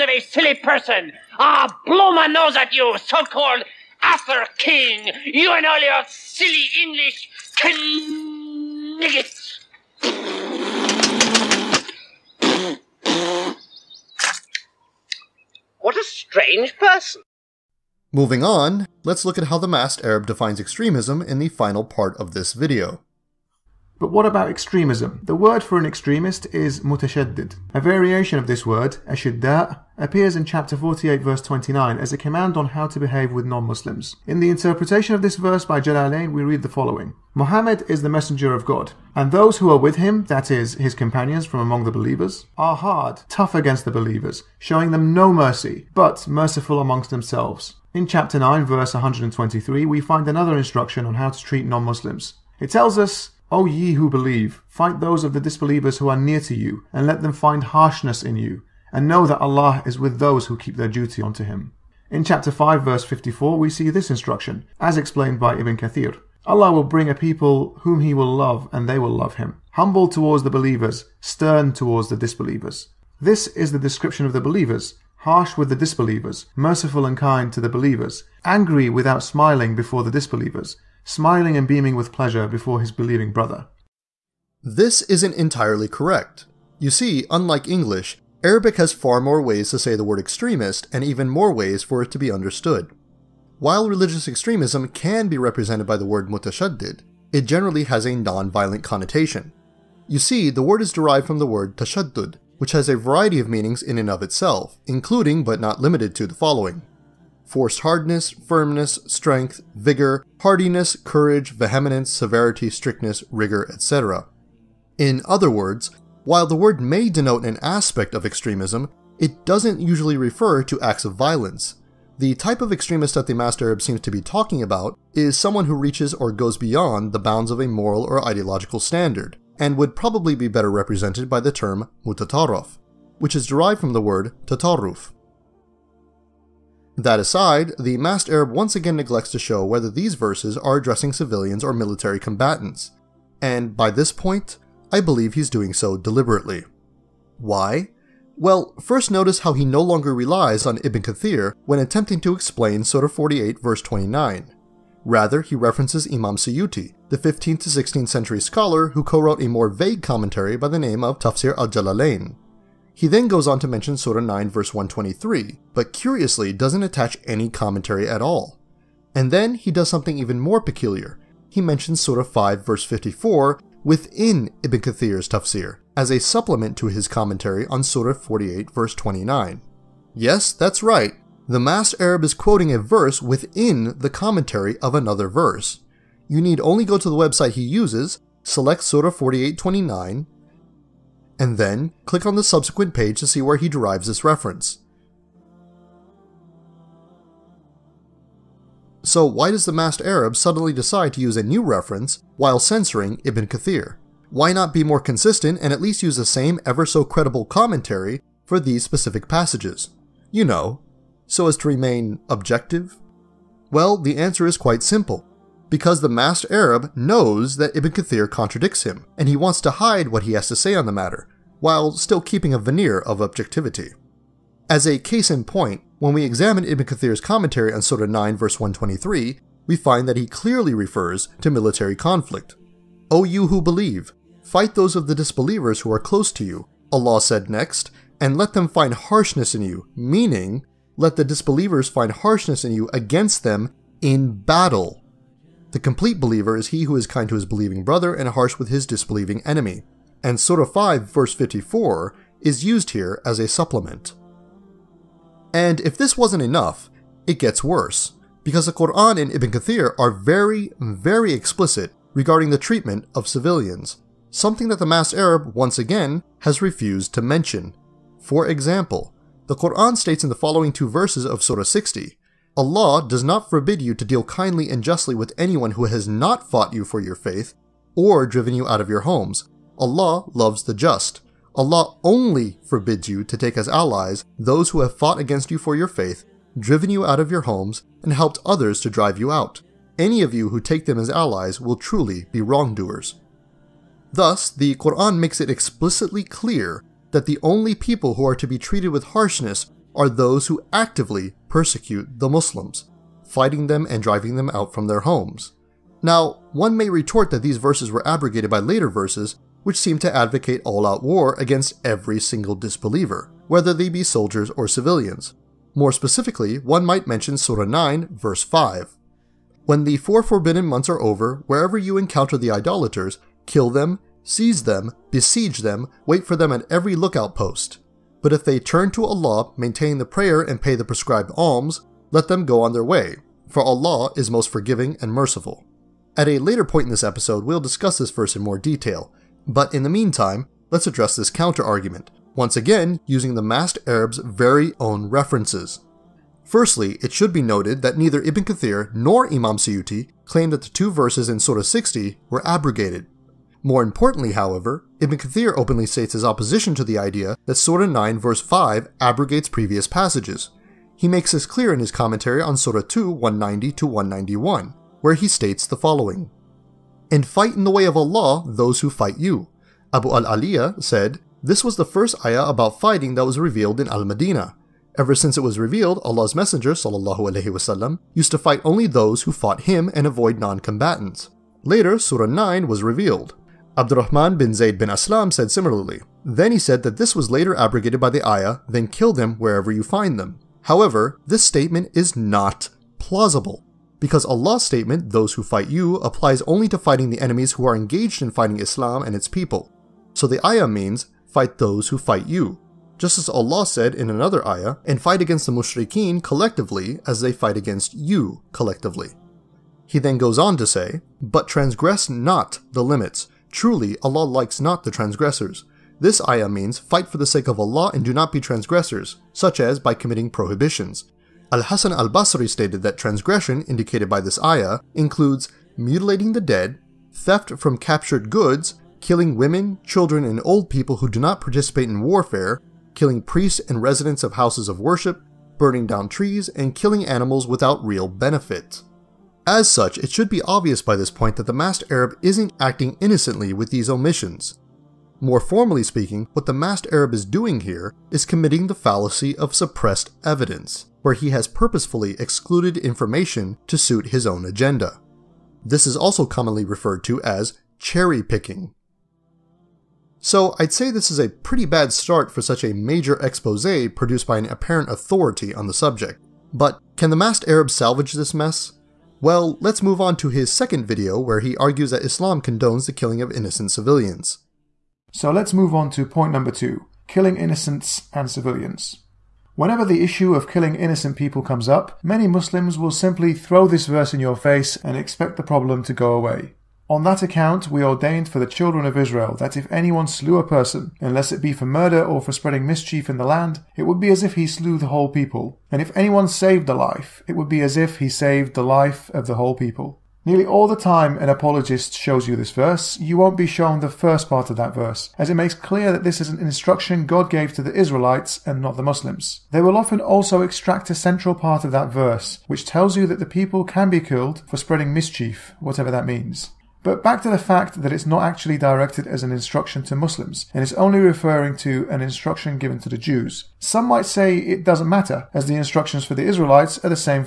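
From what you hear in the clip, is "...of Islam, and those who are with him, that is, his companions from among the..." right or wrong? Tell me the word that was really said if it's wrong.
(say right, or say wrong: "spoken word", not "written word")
wrong: "God", not "Islam".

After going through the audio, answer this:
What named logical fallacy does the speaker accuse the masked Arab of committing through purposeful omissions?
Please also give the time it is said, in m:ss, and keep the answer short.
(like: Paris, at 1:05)
suppressed evidence, at 7:28.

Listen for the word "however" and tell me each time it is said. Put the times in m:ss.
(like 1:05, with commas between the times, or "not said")
5:54, 6:30.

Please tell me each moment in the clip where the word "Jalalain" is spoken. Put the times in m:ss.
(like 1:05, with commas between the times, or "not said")
0:35, 2:41.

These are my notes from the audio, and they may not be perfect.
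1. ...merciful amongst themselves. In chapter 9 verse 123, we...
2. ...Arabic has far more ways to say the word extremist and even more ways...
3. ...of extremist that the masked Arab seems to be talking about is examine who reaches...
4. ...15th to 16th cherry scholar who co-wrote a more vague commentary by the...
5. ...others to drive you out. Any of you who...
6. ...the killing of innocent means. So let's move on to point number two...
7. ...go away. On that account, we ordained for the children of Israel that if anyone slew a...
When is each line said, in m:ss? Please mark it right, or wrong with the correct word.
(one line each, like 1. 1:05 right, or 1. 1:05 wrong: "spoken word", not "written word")
1. 0:46 right
2. 1:28 right
3. 2:02 wrong: "someone", not "examine"
4. 2:37 wrong: "century", not "cherry"
5. 4:48 right
6. 7:52 wrong: "civilians", not "means"
7. 8:05 right.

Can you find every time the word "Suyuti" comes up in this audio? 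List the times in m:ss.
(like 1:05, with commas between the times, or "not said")
2:36, 5:49.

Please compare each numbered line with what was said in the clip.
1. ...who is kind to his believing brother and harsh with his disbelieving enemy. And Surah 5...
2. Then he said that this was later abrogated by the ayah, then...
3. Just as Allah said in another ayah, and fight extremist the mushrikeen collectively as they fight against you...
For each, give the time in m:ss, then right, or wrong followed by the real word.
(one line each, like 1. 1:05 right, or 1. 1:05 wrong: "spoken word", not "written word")
1. 4:06 right
2. 6:26 right
3. 6:42 wrong: "against", not "extremist".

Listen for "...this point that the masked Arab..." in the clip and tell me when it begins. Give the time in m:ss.
7:20.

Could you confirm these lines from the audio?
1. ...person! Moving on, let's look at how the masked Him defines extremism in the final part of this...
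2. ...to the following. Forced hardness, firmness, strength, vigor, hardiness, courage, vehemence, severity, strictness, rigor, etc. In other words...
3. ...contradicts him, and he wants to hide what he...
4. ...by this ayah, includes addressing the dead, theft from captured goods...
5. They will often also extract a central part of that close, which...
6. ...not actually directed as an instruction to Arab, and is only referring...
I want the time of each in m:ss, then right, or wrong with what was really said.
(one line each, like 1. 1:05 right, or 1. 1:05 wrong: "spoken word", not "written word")
1. 0:16 wrong: "Arab", not "Him"
2. 1:46 right
3. 3:38 right
4. 7:04 wrong: "mutilating", not "addressing"
5. 8:29 wrong: "verse", not "close"
6. 8:38 wrong: "Muslims", not "Arab".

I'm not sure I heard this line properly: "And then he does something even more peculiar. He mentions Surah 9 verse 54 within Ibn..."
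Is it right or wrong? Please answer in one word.
wrong.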